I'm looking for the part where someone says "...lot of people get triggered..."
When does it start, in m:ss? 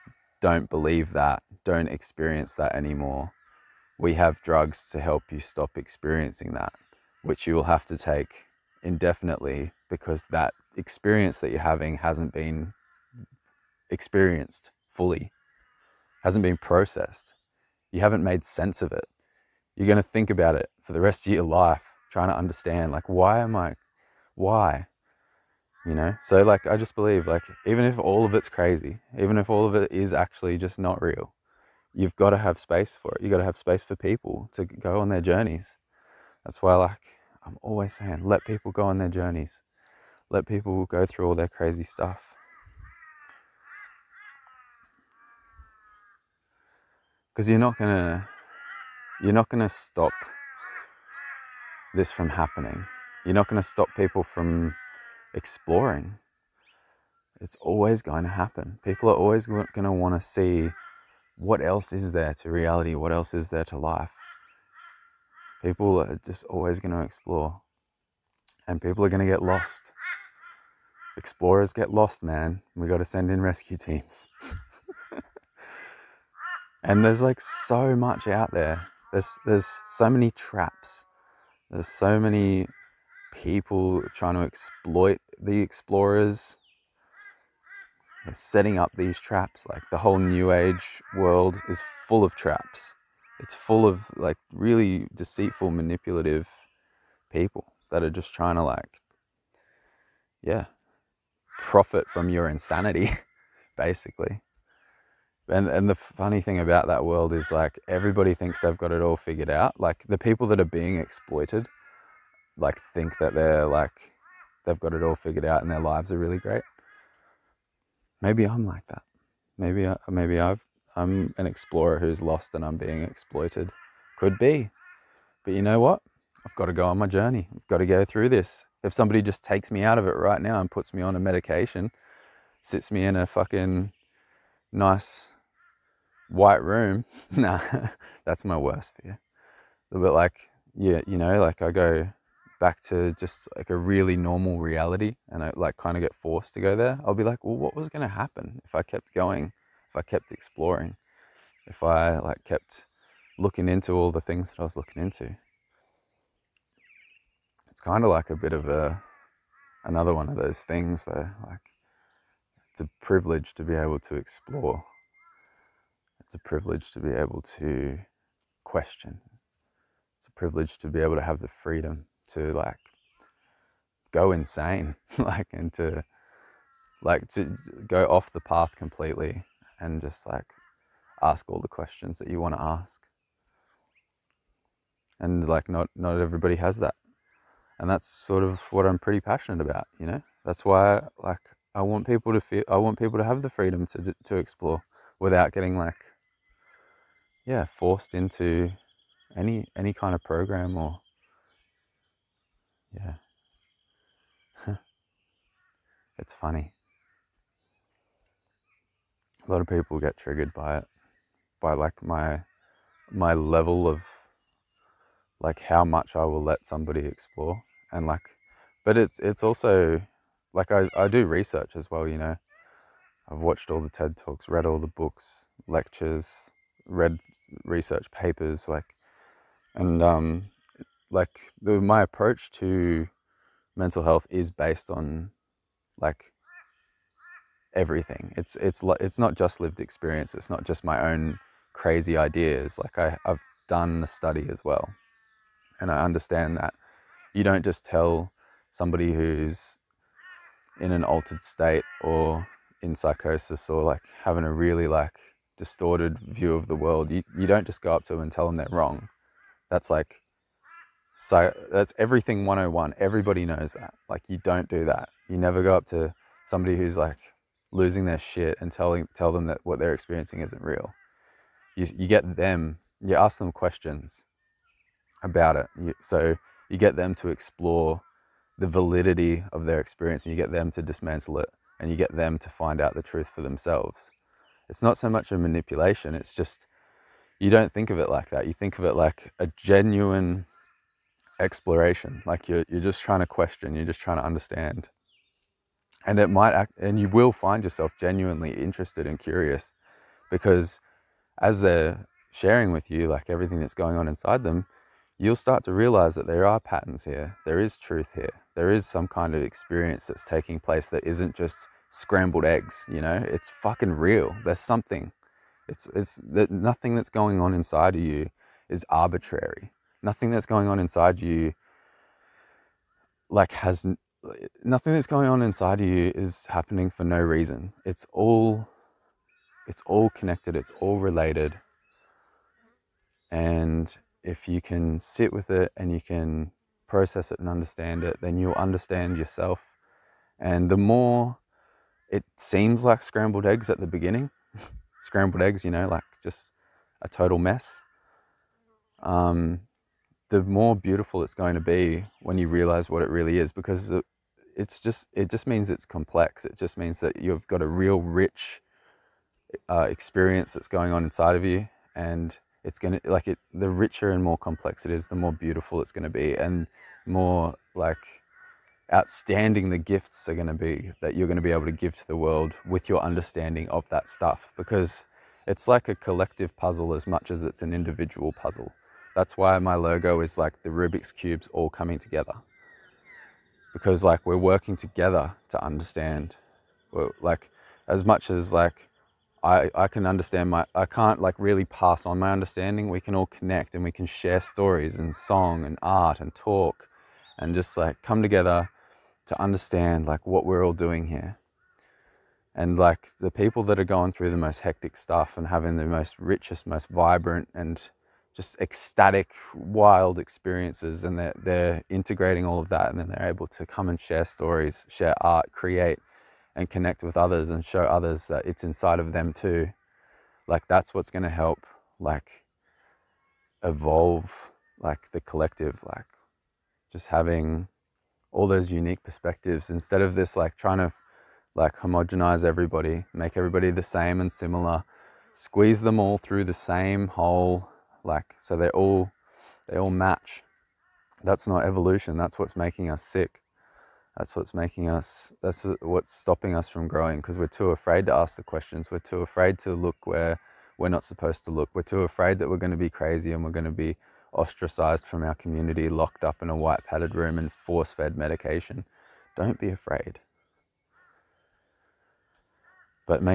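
3:29.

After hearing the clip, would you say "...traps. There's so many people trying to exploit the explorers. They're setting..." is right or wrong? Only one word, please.
right.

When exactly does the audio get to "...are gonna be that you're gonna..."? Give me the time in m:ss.
6:10.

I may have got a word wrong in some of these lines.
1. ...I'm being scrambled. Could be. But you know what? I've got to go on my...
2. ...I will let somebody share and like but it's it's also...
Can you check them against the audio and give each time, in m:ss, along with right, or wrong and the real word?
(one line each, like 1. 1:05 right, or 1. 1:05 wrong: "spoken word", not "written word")
1. 2:02 wrong: "exploited", not "scrambled"
2. 3:36 wrong: "explore", not "share".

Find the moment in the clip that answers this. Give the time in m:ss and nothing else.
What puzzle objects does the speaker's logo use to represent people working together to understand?
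6:20.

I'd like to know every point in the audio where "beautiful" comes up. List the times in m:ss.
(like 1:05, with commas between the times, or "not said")
5:50, 6:05.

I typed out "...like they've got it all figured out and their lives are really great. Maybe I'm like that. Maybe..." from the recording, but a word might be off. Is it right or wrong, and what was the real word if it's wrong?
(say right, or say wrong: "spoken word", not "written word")
right.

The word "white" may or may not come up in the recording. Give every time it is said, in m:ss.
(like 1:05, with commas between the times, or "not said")
2:16, 7:36.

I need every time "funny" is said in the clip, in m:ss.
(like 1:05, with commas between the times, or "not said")
1:45, 3:26.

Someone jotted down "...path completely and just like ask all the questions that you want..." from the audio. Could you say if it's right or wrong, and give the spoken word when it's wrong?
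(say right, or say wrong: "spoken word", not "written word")
right.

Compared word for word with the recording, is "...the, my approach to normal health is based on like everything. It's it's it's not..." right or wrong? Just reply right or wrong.
wrong.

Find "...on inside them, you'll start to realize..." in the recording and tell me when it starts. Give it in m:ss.
5:03.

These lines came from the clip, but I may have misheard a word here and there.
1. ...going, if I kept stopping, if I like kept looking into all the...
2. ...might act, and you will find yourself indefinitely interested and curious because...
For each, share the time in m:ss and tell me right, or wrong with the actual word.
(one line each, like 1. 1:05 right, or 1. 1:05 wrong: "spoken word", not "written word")
1. 2:29 wrong: "exploring", not "stopping"
2. 4:56 wrong: "genuinely", not "indefinitely".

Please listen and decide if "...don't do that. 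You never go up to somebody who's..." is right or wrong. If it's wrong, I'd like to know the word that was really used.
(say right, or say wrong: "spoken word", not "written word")
right.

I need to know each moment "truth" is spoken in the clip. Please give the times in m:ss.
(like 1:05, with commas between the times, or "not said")
4:43, 5:07.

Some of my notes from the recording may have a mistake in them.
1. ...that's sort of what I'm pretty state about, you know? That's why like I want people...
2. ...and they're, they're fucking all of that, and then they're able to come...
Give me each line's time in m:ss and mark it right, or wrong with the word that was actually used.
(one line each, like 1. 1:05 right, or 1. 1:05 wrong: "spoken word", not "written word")
1. 3:07 wrong: "passionate", not "state"
2. 6:51 wrong: "integrating", not "fucking".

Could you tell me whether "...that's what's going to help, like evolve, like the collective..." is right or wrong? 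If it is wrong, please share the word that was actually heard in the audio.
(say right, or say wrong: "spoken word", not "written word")
right.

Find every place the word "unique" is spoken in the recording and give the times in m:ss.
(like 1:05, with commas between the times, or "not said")
7:08.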